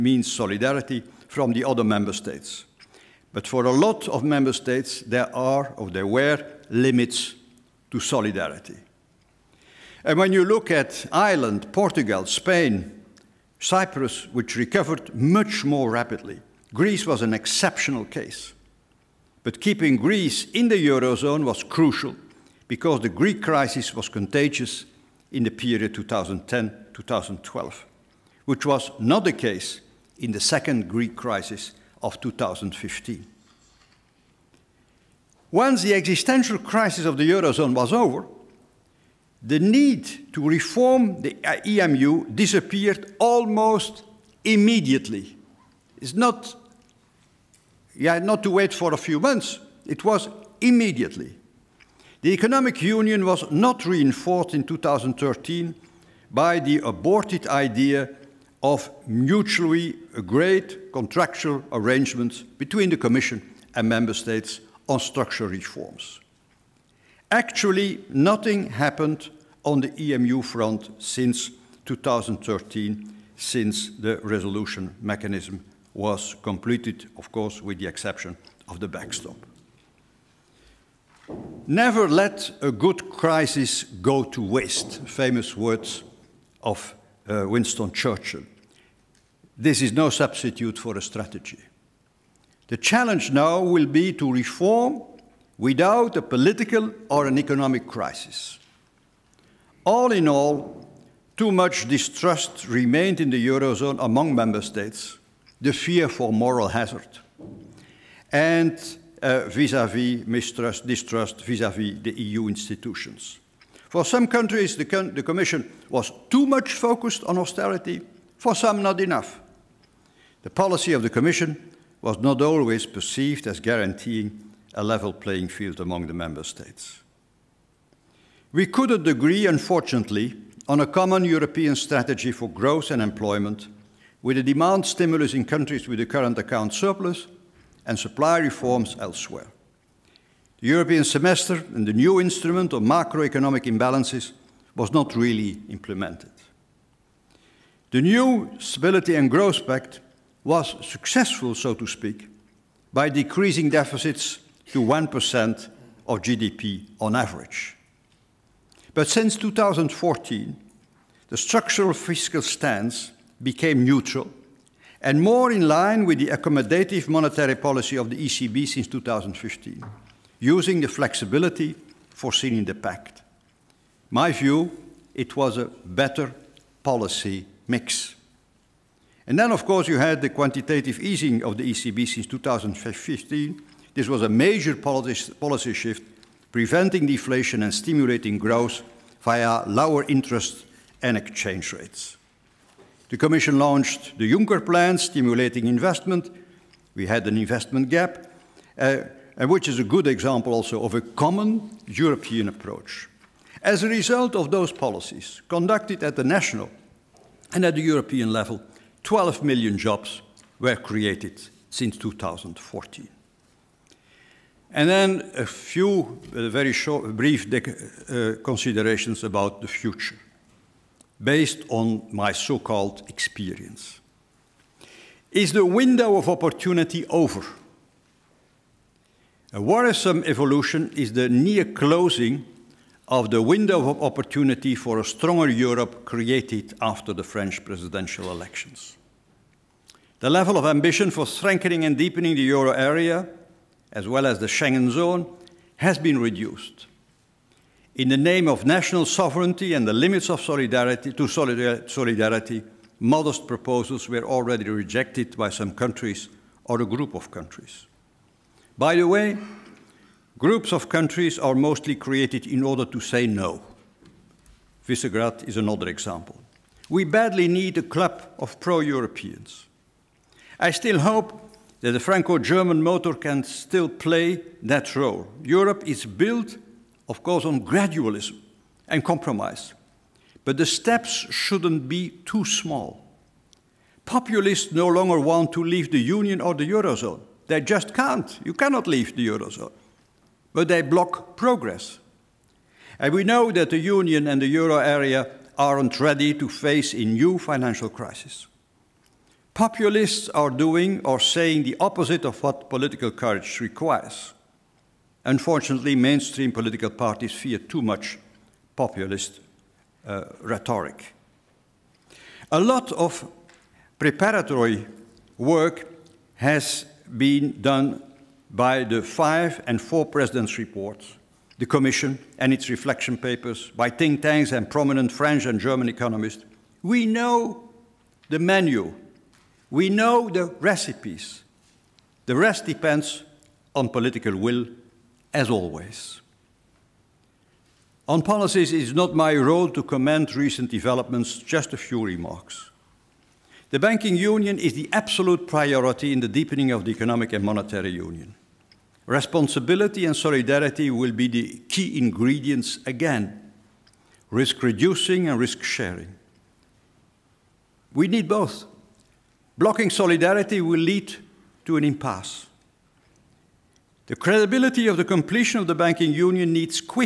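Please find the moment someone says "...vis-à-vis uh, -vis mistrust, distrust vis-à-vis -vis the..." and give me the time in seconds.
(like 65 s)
109 s.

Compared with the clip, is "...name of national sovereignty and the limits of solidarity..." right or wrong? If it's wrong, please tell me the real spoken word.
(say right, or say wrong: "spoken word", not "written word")
right.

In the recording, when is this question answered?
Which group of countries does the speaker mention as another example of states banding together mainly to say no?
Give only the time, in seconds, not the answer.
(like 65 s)
264 s.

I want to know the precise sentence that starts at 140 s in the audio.
The European semester and the new instrument of macroeconomic imbalances was not really implemented.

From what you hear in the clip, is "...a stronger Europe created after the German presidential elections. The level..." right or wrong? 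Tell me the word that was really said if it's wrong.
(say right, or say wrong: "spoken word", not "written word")
wrong: "French", not "German".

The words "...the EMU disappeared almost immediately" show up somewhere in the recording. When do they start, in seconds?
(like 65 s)
41 s.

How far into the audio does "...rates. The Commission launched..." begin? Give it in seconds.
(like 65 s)
191 s.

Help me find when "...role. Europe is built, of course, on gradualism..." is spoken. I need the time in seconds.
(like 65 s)
274 s.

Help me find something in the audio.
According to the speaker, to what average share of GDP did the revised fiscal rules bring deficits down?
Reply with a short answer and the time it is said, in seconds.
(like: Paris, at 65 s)
1%, at 154 s.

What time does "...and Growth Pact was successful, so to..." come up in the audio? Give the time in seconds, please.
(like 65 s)
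149 s.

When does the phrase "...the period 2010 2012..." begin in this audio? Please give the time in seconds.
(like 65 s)
25 s.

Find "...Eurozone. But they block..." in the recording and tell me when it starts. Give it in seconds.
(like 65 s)
289 s.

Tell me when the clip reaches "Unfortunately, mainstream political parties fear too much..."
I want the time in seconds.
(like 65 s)
305 s.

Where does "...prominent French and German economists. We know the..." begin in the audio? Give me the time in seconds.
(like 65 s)
324 s.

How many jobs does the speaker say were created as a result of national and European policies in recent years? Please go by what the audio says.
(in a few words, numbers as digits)
12 million.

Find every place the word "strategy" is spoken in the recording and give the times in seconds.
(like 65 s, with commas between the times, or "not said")
91 s, 131 s.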